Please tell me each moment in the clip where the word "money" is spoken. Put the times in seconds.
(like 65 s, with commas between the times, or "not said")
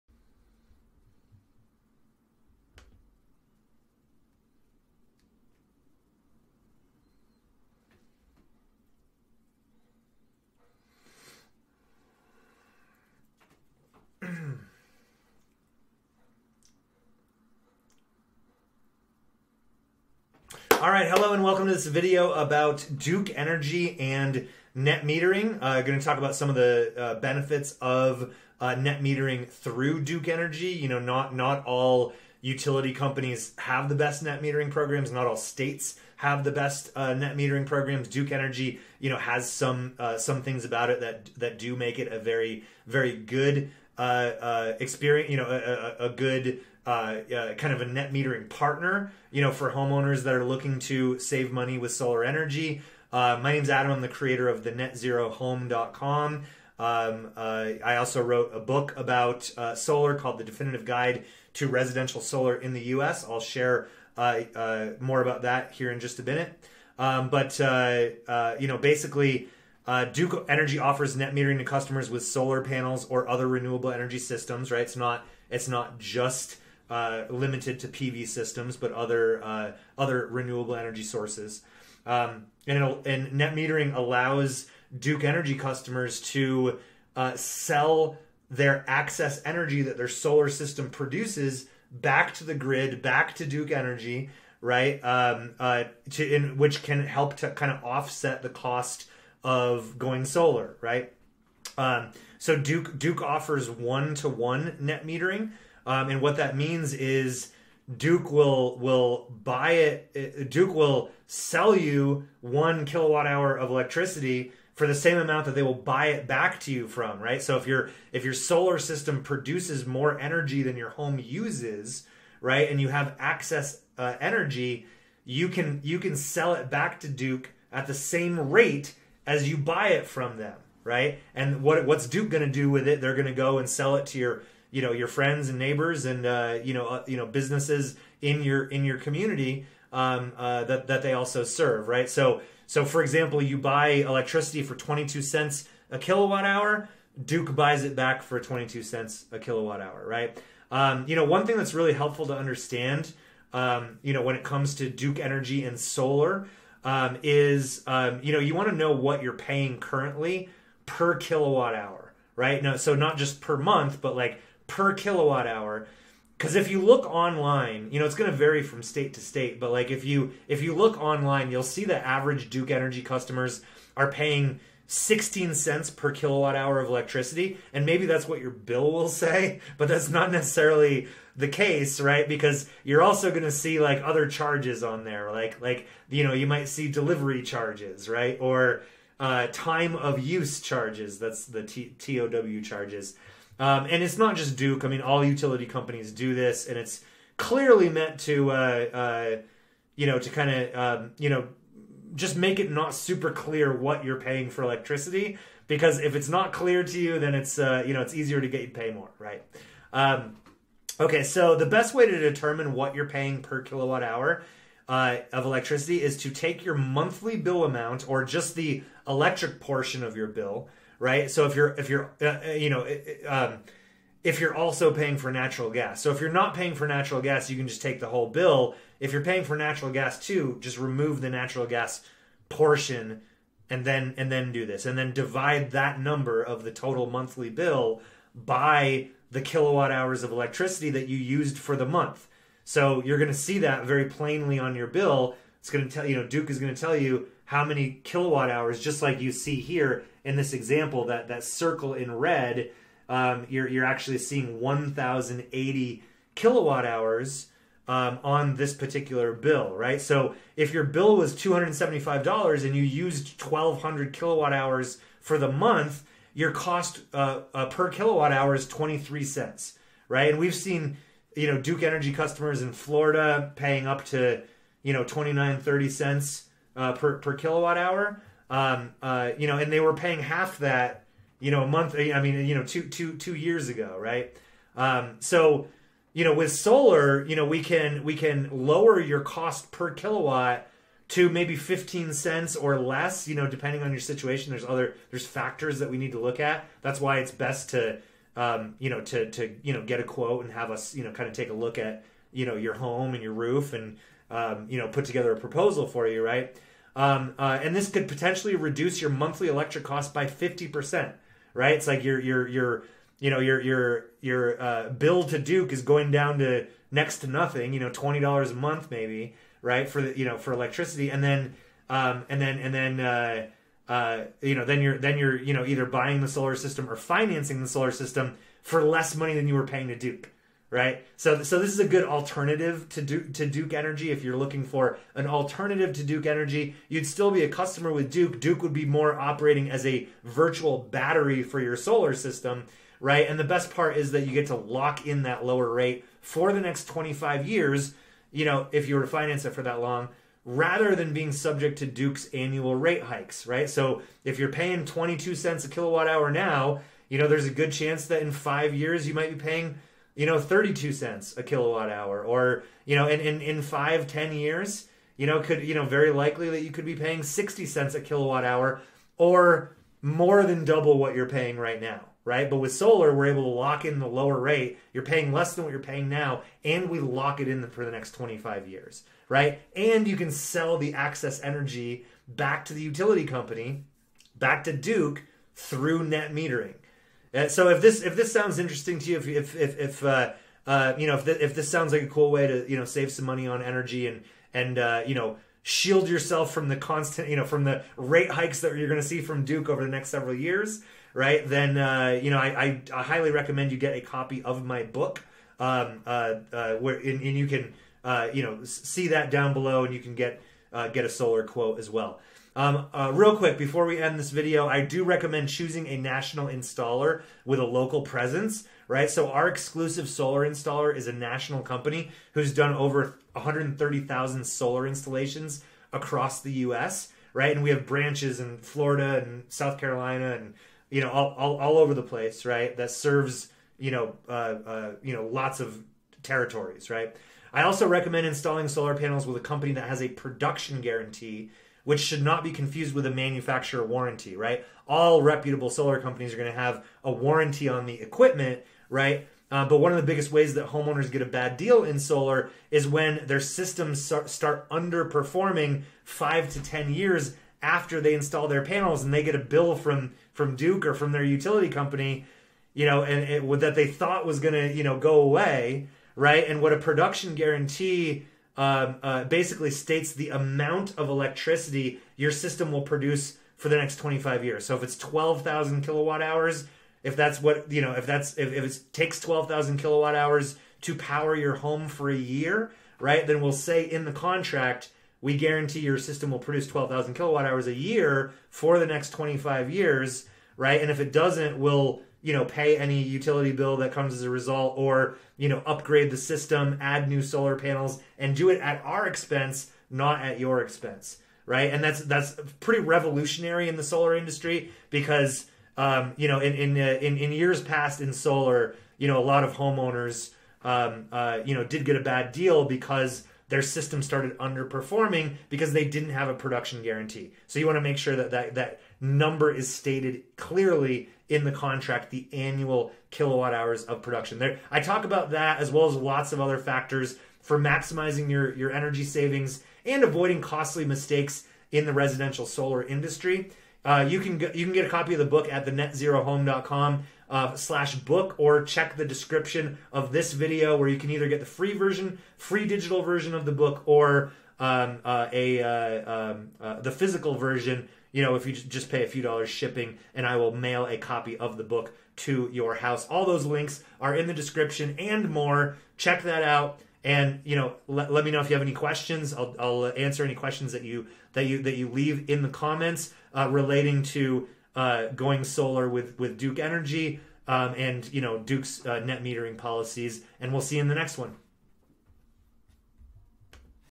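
51 s, 329 s, 393 s.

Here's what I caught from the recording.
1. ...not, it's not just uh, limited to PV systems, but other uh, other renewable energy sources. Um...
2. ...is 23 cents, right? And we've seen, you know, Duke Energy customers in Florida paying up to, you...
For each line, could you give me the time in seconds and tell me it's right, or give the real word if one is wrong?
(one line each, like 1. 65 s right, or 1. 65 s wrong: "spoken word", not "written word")
1. 74 s right
2. 268 s right.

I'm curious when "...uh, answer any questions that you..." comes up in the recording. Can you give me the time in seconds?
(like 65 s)
559 s.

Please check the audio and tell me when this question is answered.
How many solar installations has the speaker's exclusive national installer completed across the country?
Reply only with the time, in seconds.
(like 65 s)
423 s.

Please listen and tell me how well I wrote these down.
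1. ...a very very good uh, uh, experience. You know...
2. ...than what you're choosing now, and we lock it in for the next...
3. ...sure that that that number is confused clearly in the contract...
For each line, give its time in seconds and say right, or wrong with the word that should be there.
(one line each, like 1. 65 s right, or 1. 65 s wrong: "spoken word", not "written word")
1. 42 s right
2. 375 s wrong: "paying", not "choosing"
3. 517 s wrong: "stated", not "confused".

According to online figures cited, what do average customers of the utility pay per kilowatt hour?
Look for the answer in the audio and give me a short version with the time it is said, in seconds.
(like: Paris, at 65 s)
16 cents, at 174 s.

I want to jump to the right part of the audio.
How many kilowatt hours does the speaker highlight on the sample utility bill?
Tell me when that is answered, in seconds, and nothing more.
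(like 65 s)
254 s.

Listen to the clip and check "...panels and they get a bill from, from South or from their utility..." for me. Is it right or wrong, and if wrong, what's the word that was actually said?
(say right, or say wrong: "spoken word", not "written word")
wrong: "Duke", not "South".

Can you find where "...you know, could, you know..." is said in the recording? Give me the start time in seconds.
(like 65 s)
365 s.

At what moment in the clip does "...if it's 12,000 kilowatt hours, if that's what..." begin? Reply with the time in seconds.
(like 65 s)
474 s.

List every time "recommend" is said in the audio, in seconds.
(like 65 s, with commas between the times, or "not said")
403 s, 415 s, 437 s.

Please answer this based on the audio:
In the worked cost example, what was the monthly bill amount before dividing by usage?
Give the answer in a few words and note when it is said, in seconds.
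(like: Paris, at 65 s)
$275, at 261 s.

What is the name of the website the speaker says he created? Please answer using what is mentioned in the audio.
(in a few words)
thenetzerohome.com.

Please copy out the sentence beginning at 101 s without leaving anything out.
Um, so Duke Duke offers one to one net metering um, and what that means is Duke will will buy it.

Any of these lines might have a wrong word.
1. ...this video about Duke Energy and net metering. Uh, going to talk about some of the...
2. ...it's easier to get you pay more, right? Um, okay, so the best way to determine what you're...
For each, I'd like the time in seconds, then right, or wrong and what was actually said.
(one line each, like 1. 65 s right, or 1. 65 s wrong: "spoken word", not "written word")
1. 21 s right
2. 208 s right.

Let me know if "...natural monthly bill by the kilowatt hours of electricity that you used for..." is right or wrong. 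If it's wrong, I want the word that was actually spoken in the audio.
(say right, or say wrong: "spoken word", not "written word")
wrong: "total", not "natural".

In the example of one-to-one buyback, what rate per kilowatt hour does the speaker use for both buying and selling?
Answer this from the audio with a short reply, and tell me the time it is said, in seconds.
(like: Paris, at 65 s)
22 cents, at 144 s.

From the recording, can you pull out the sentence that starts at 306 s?
Um, uh, and this could potentially reduce your monthly electric cost by 50%, right?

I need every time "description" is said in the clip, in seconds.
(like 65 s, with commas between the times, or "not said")
539 s, 554 s.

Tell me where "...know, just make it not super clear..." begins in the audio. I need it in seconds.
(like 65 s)
201 s.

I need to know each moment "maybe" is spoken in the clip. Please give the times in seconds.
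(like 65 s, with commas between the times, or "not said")
177 s, 291 s, 318 s.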